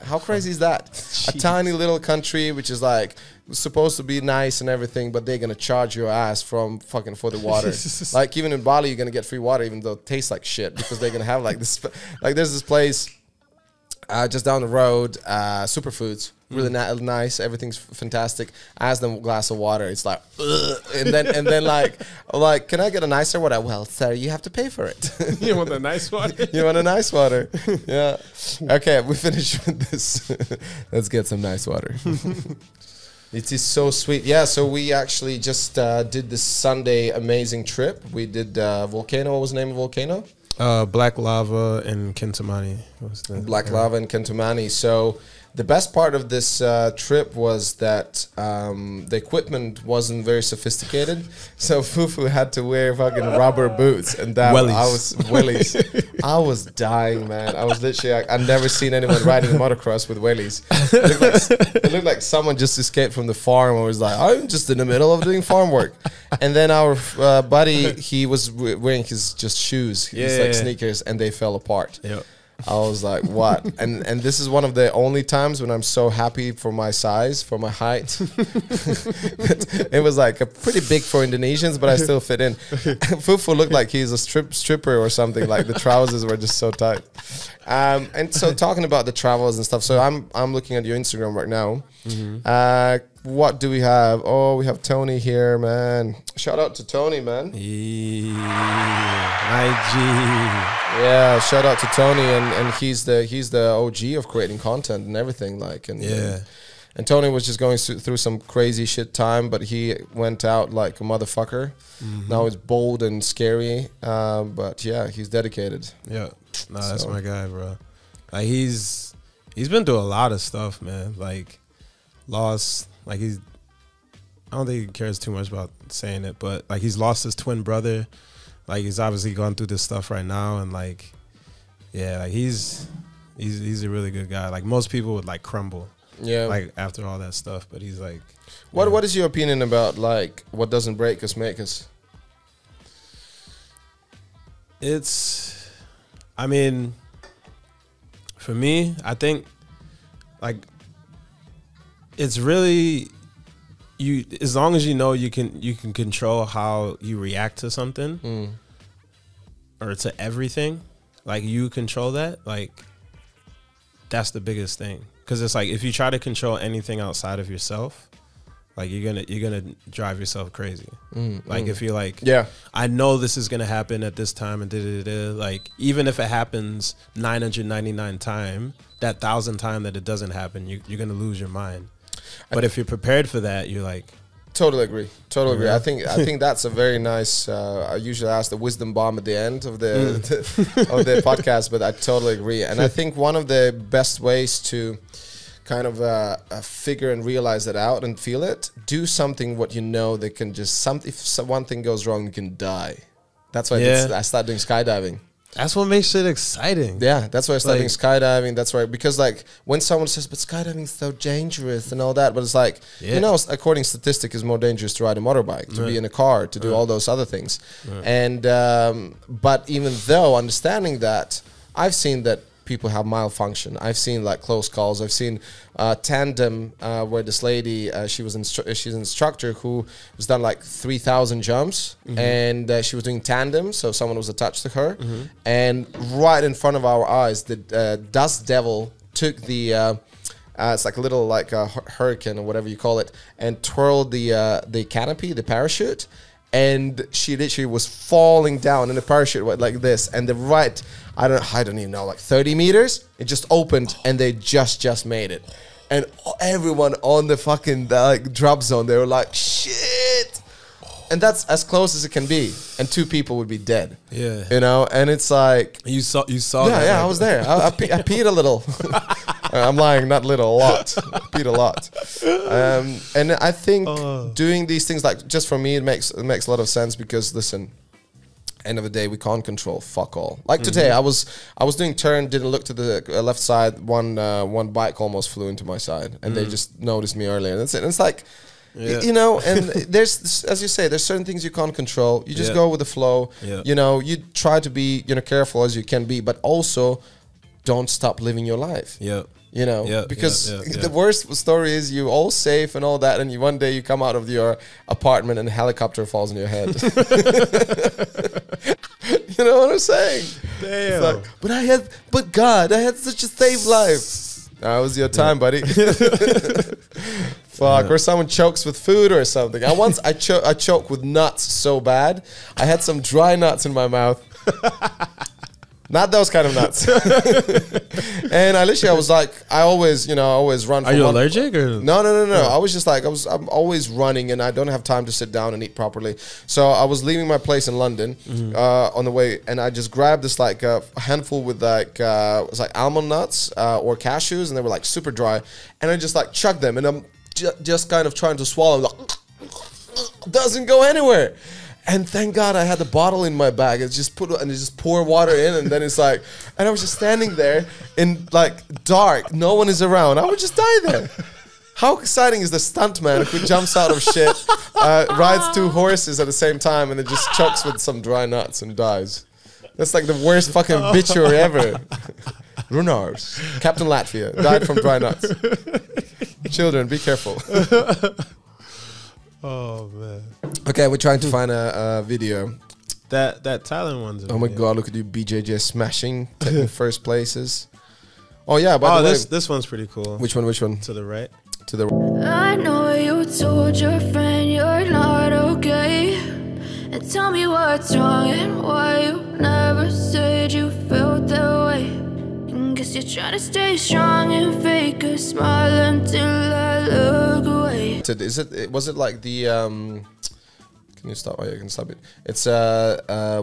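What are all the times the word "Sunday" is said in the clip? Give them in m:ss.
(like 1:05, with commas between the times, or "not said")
0:36.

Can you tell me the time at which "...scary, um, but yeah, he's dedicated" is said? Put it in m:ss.
1:53.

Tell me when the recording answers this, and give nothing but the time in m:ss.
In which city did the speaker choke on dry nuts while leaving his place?
5:37.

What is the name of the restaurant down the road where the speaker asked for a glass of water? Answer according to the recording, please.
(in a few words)
Superfoods.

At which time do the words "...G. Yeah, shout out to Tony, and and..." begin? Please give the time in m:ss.
1:40.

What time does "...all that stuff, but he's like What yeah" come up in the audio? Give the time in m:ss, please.
2:17.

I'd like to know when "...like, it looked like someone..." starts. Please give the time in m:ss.
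1:01.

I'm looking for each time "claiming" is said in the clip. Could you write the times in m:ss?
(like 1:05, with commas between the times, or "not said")
not said.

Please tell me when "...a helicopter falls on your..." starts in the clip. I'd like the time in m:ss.
5:05.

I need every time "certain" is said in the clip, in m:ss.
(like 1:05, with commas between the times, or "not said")
4:51.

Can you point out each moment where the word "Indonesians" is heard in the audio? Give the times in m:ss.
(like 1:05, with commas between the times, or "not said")
1:21.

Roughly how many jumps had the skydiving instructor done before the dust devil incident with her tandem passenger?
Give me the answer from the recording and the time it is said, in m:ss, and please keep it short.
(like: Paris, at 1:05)
3000, at 3:50.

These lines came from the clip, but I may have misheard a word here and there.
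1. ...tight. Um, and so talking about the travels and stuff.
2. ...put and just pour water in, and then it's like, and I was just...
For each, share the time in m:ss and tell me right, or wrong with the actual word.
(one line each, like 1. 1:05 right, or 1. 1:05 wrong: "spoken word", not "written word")
1. 1:26 right
2. 5:54 right.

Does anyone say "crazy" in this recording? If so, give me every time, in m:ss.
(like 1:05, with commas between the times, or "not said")
0:00, 1:48, 2:50.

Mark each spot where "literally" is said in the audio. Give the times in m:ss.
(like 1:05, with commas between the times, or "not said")
0:57, 4:07, 5:28.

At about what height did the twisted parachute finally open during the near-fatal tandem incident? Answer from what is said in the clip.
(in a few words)
30 meters.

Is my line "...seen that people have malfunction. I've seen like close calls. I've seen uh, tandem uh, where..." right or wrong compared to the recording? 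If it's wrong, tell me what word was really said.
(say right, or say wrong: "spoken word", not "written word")
right.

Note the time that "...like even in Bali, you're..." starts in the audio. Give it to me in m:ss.
0:08.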